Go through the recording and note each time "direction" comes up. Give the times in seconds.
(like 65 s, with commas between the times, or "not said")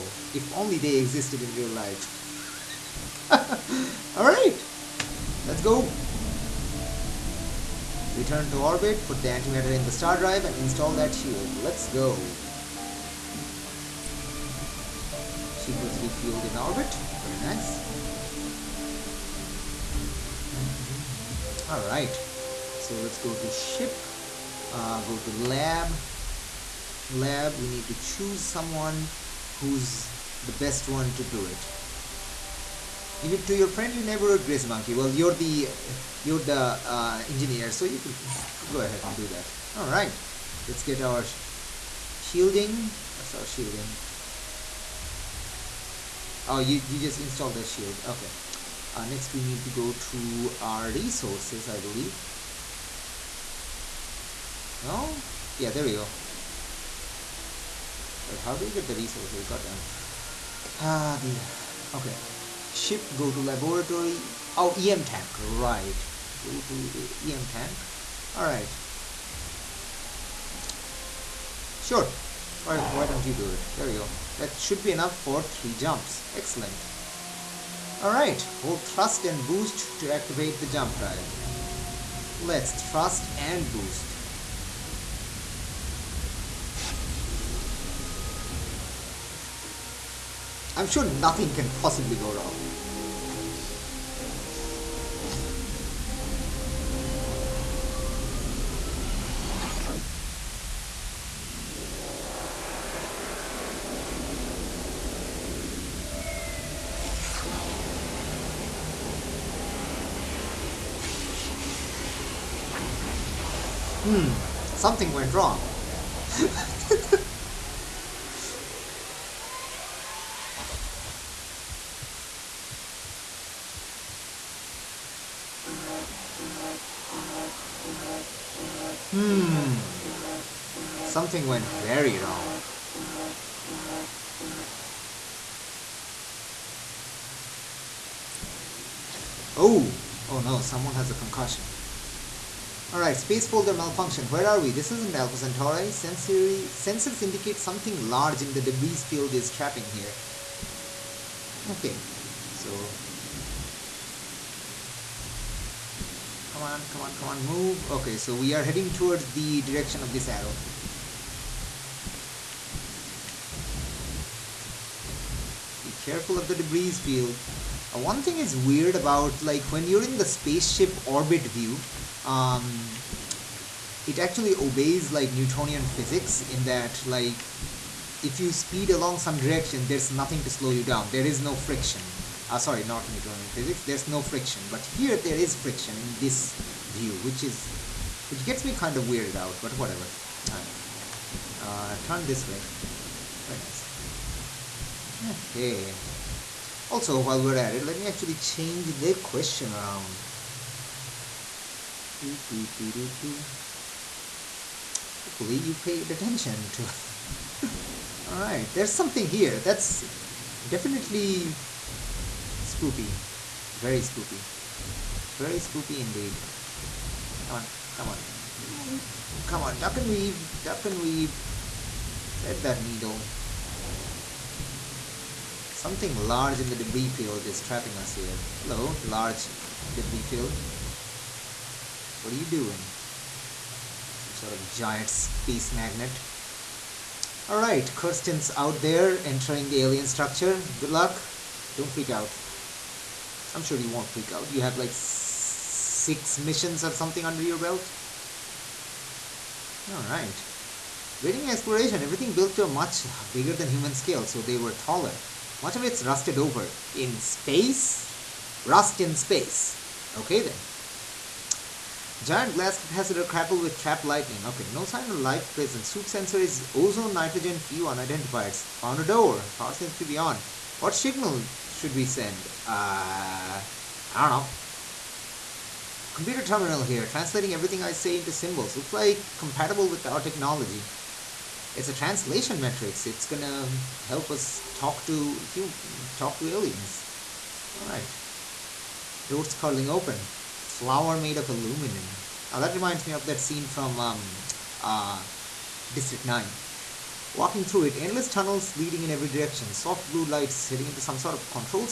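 159 s, 179 s, 299 s.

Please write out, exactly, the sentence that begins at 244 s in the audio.
You have like six missions or something under your belt.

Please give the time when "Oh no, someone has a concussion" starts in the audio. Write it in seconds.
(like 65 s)
140 s.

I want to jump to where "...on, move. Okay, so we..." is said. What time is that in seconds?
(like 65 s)
157 s.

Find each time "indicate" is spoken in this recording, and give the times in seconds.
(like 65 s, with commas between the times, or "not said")
147 s.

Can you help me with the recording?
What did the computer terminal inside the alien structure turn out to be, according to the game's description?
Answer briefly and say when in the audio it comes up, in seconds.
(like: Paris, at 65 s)
a translation matrix, at 281 s.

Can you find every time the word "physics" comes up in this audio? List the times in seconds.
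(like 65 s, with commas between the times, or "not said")
175 s, 183 s.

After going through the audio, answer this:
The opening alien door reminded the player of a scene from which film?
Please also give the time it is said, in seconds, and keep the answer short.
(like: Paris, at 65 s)
District 9, at 295 s.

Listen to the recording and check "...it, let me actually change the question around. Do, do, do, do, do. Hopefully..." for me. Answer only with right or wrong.
right.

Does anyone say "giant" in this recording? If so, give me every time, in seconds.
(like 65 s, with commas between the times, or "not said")
234 s, 262 s.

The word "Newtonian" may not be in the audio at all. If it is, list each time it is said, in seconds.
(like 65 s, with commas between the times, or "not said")
175 s, 183 s.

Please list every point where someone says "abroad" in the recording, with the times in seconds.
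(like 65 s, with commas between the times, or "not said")
not said.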